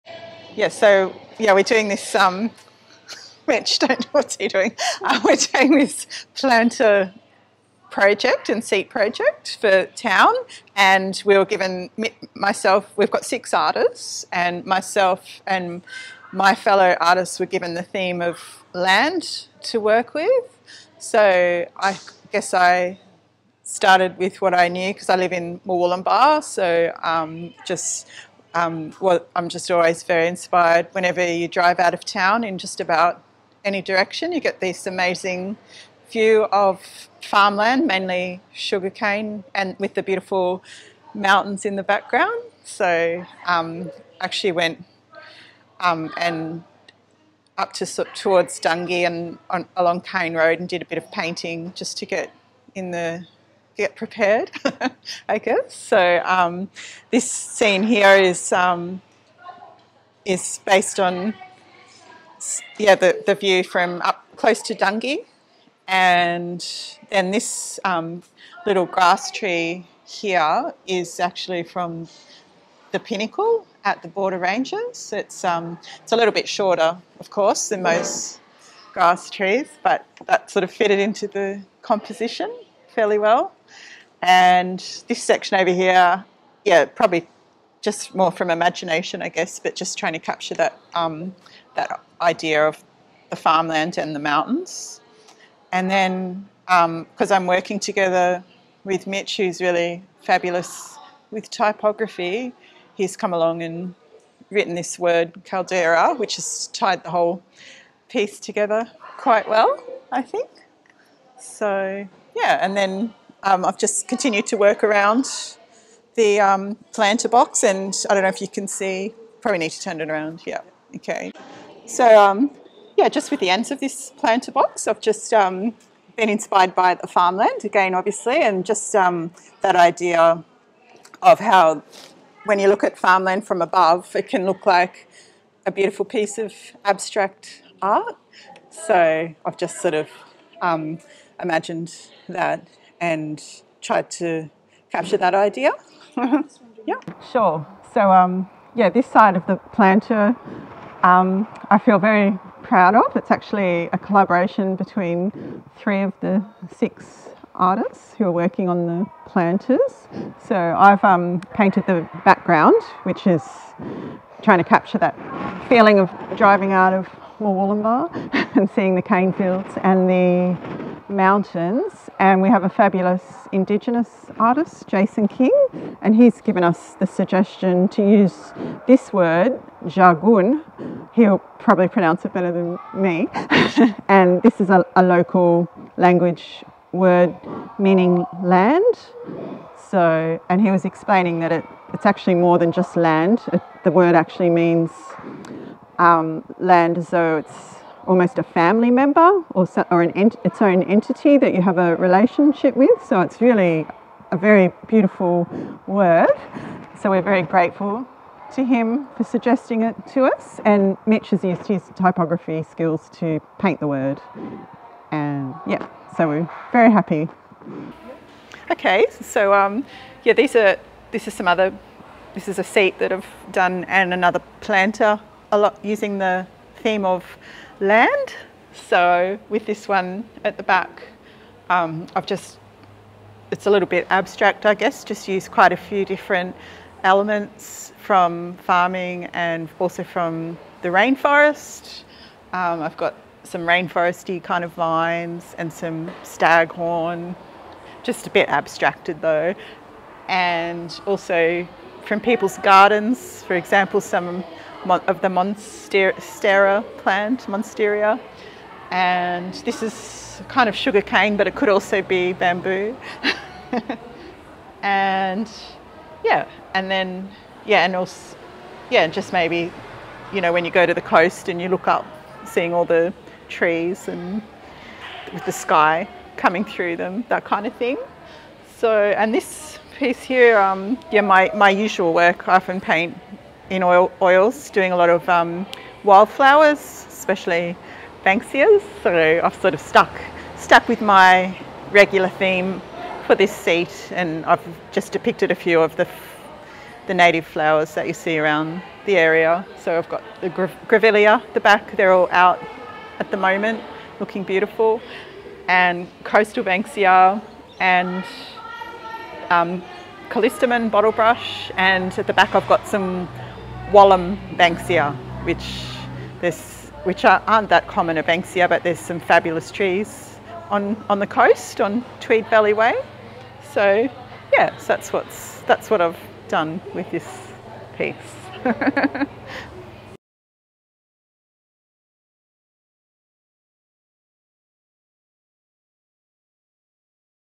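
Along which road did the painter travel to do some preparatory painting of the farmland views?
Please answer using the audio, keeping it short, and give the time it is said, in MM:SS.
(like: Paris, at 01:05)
Cane Road, at 00:50.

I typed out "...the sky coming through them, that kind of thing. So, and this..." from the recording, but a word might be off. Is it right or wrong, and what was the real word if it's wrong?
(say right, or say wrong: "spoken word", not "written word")
right.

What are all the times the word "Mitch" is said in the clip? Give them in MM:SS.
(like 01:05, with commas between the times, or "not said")
01:39, 03:31.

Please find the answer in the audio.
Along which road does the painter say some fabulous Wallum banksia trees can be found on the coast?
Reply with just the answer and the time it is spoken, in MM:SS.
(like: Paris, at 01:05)
Tweed Valley Way, at 05:22.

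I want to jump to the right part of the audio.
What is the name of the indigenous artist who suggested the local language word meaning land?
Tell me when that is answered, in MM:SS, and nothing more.
02:54.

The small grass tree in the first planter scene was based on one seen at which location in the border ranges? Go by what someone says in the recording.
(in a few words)
the Pinnacle.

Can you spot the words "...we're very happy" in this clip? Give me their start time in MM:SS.
03:36.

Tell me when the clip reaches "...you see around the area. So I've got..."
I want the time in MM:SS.
04:58.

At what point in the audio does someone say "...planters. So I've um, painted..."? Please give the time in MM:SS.
02:39.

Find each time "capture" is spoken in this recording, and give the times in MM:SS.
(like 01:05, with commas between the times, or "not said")
01:30, 02:24, 02:44.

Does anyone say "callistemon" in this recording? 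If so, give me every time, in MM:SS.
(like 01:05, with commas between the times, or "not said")
05:10.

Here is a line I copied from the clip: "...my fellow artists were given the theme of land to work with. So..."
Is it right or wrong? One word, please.
right.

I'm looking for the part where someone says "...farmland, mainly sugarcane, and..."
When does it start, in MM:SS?
00:37.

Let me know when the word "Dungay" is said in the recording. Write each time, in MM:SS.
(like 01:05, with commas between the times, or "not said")
00:48, 01:04.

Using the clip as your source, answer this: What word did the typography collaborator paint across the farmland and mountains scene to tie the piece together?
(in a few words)
Caldera.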